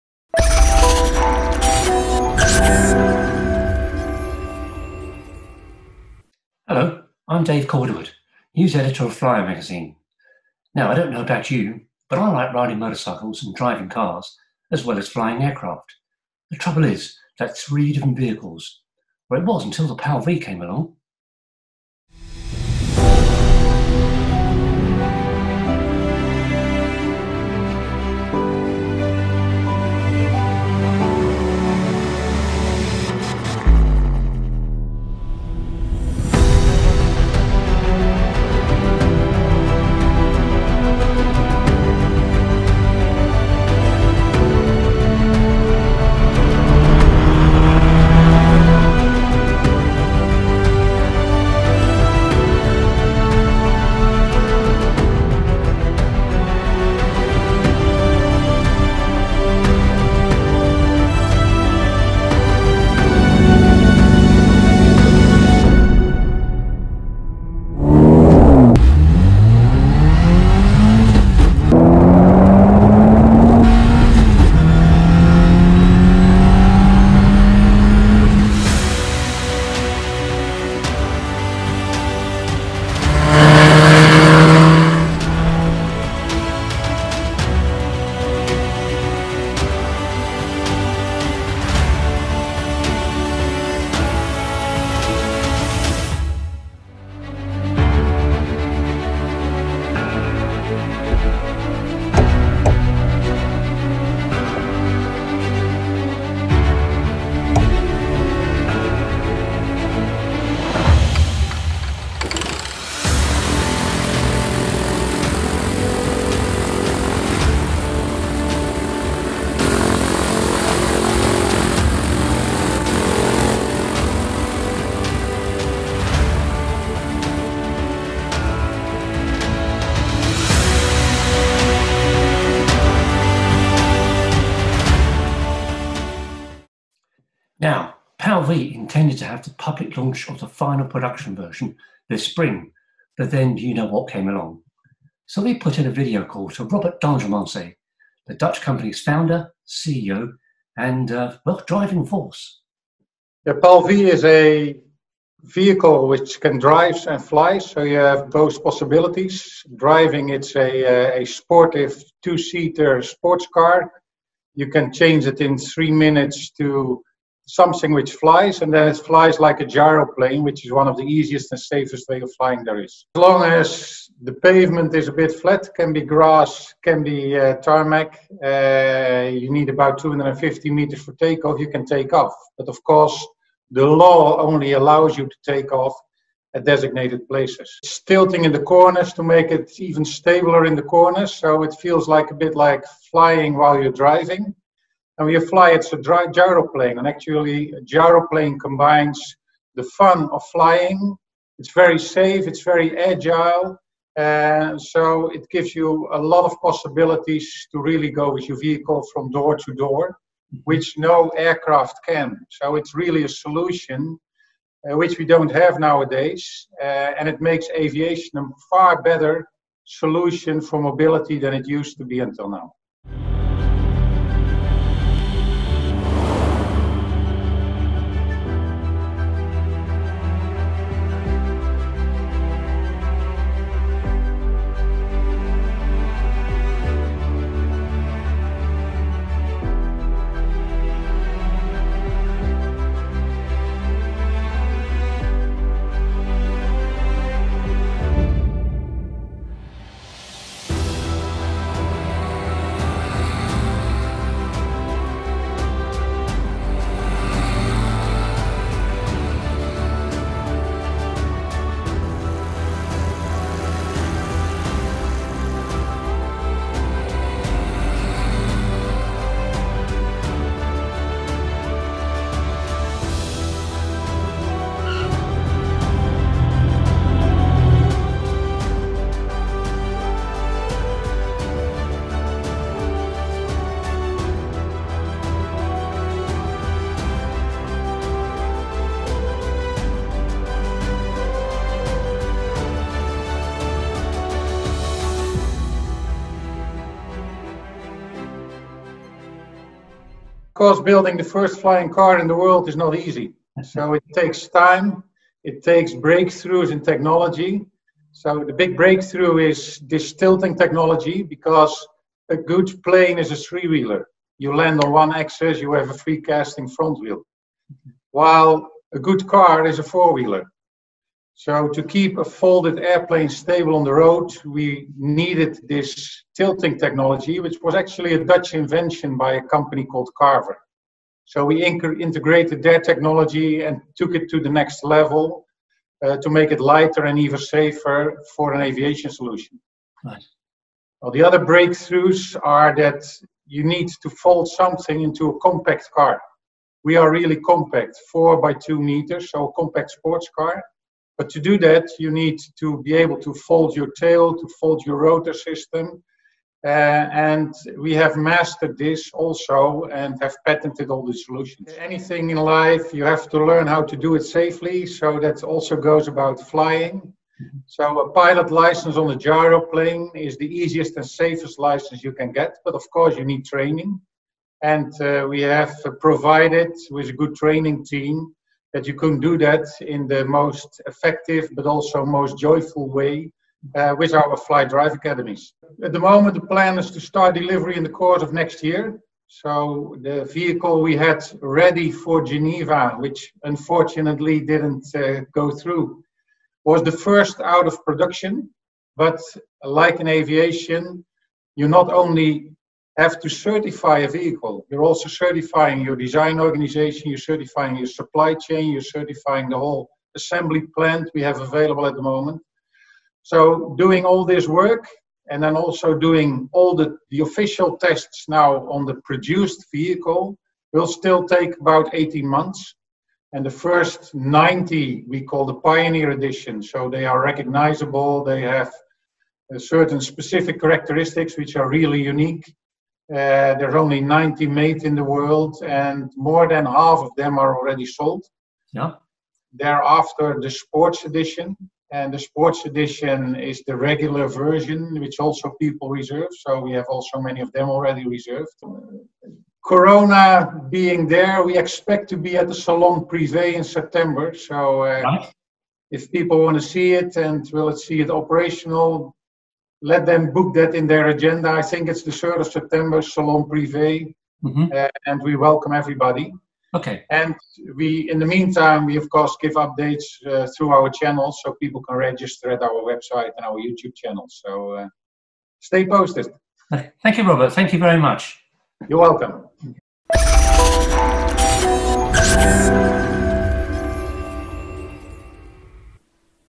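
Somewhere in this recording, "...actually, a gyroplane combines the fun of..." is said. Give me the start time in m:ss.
3:17.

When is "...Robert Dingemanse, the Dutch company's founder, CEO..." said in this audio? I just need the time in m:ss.
2:26.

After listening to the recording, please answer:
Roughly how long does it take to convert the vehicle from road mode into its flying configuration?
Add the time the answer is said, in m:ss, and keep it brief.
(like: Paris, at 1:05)
3 minutes, at 2:45.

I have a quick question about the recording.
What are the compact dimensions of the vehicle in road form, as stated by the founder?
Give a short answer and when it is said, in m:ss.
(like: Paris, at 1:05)
4 by 2 meters, at 5:48.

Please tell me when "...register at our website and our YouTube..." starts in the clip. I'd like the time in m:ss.
7:51.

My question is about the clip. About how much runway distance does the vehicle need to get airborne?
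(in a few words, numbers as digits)
250 meters.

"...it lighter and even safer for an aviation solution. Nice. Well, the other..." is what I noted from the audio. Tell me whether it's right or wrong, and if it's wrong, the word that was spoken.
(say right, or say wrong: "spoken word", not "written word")
right.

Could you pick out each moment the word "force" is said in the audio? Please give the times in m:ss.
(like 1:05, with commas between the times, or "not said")
2:32.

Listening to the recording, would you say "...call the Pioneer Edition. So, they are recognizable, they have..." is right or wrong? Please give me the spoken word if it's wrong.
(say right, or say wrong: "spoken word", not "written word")
right.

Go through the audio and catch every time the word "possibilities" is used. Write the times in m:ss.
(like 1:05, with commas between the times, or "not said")
2:38, 3:26.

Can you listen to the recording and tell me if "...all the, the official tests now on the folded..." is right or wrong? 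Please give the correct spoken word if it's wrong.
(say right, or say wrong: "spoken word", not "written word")
wrong: "produced", not "folded".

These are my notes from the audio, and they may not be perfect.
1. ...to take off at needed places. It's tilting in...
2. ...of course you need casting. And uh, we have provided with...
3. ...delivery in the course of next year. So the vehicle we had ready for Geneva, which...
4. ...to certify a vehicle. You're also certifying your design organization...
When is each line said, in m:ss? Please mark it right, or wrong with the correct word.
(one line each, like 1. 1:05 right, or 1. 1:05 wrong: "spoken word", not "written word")
1. 3:05 wrong: "designated", not "needed"
2. 6:12 wrong: "training", not "casting"
3. 6:27 right
4. 6:43 right.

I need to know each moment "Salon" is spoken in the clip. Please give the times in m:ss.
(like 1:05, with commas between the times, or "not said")
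7:32, 7:43.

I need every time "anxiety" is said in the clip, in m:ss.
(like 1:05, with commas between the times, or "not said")
not said.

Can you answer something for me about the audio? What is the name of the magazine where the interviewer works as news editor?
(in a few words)
Flyer.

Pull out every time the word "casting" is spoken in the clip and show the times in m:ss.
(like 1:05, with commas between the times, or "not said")
5:16.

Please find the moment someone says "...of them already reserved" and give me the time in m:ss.
7:27.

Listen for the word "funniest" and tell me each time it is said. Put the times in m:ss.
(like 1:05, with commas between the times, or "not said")
not said.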